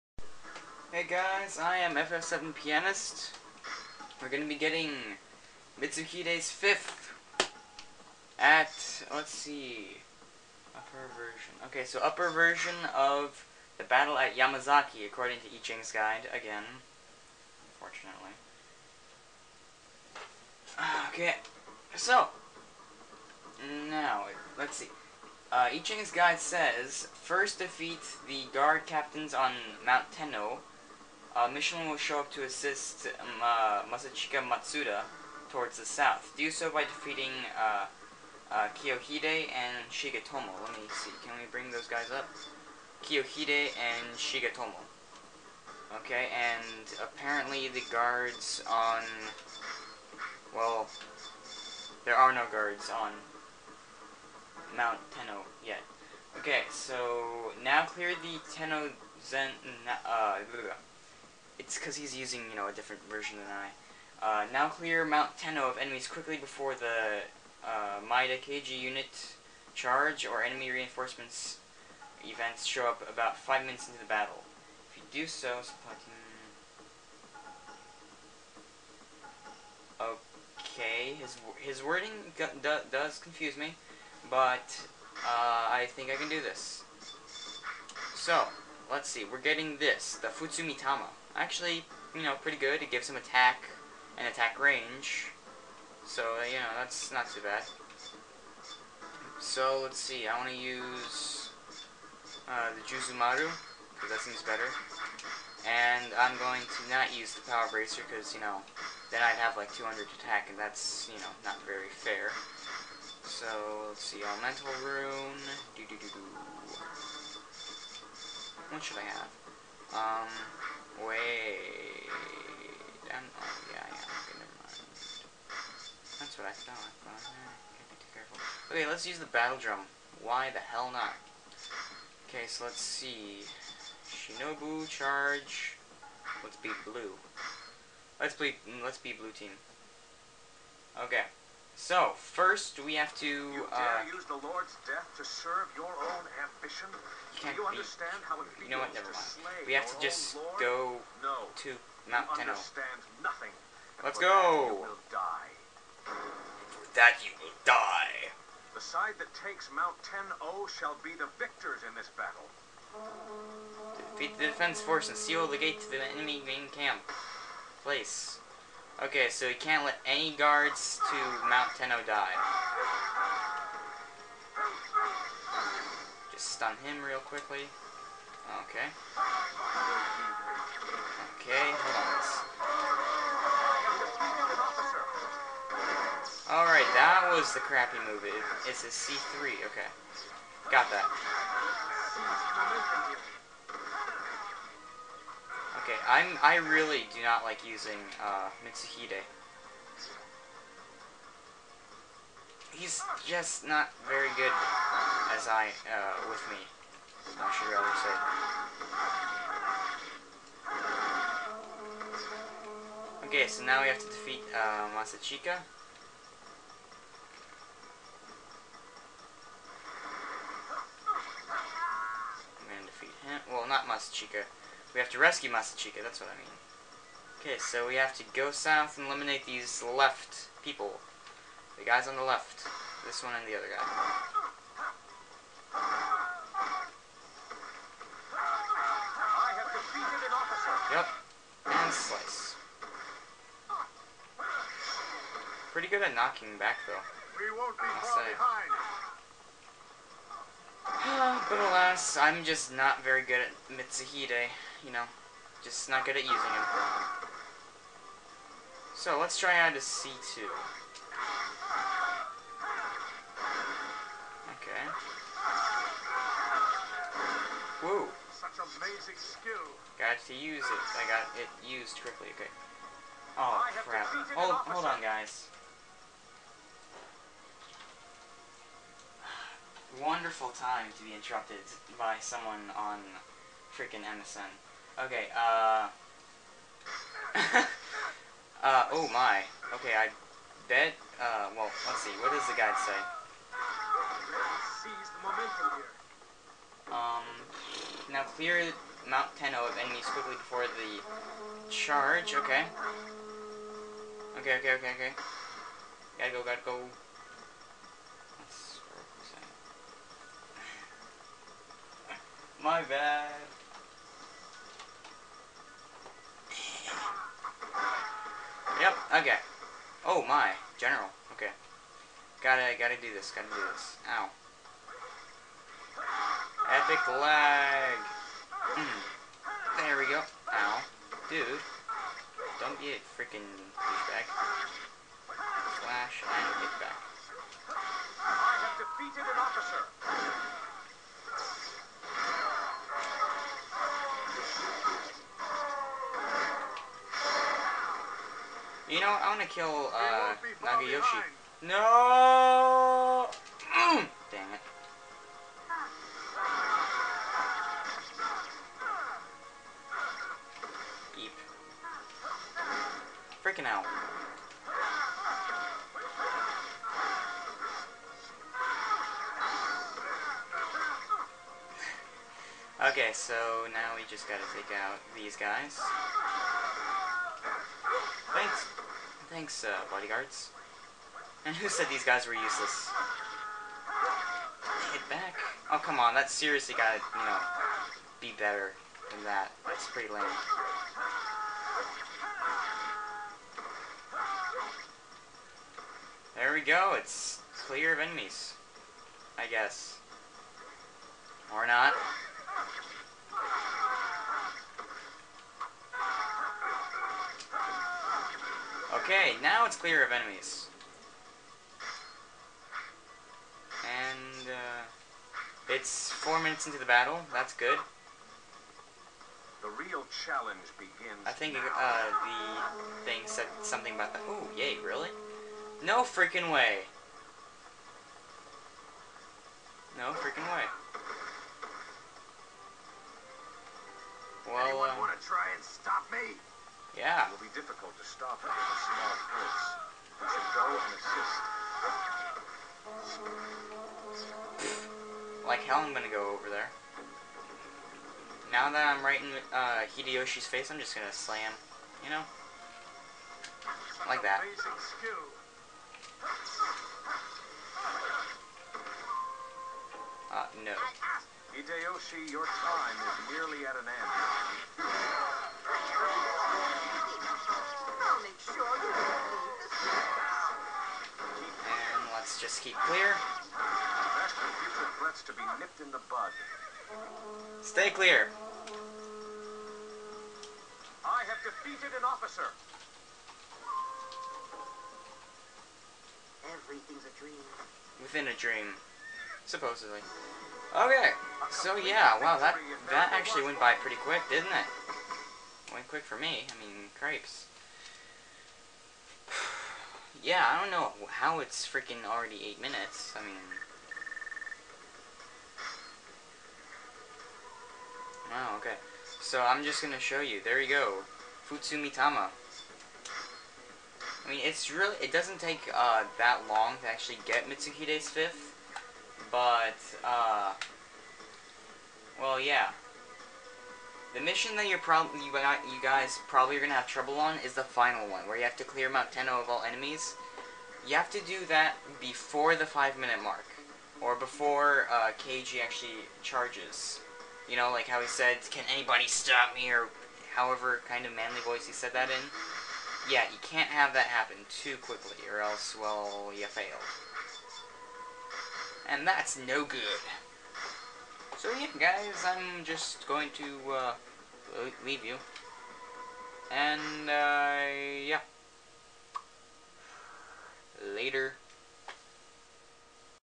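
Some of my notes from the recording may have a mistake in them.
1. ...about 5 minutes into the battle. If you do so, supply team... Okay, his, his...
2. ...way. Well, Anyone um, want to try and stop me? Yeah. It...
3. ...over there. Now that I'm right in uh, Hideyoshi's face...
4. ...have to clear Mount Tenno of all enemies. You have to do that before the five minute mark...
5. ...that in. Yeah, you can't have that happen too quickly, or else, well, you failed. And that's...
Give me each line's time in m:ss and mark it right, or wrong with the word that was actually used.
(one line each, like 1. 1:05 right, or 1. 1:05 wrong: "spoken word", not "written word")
1. 1:13 right
2. 7:10 right
3. 7:26 right
4. 8:48 right
5. 9:01 right.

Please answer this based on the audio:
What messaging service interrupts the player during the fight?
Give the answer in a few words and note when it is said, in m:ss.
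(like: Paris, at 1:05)
MSN, at 4:44.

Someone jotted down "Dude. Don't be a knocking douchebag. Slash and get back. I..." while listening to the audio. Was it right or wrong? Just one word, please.
wrong.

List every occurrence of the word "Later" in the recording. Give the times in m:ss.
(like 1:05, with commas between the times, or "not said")
9:20.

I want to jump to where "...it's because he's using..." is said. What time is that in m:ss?
1:01.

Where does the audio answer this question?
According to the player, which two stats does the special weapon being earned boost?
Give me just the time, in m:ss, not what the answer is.
1:33.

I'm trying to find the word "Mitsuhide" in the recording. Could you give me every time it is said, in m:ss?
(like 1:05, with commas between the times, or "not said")
0:05, 3:18, 4:13, 8:37.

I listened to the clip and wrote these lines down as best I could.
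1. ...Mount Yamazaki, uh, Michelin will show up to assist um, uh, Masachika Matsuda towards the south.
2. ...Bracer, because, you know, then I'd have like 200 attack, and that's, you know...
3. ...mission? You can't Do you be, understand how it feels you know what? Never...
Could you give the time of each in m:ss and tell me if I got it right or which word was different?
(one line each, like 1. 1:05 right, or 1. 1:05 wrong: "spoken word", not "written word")
1. 0:29 wrong: "Tenno", not "Yamazaki"
2. 1:47 right
3. 2:26 wrong: "ambition", not "mission".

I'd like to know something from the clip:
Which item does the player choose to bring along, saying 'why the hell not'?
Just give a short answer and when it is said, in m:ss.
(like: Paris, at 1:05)
Battle drum, at 2:09.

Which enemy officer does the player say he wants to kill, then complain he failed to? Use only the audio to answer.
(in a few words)
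Nagayoshi.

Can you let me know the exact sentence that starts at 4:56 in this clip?
Um, now clear Mount Tenno of enemies quickly before the charge, okay.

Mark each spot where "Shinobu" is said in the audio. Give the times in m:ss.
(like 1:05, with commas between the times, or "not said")
2:14.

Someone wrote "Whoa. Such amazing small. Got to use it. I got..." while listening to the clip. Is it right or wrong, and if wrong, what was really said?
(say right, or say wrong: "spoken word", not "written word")
wrong: "skill", not "small".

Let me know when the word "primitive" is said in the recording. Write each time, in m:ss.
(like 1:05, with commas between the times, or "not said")
not said.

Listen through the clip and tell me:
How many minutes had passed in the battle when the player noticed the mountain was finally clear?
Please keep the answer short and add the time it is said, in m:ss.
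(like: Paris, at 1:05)
4, at 6:56.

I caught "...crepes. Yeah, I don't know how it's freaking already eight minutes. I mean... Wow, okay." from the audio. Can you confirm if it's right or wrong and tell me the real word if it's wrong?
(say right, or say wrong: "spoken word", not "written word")
right.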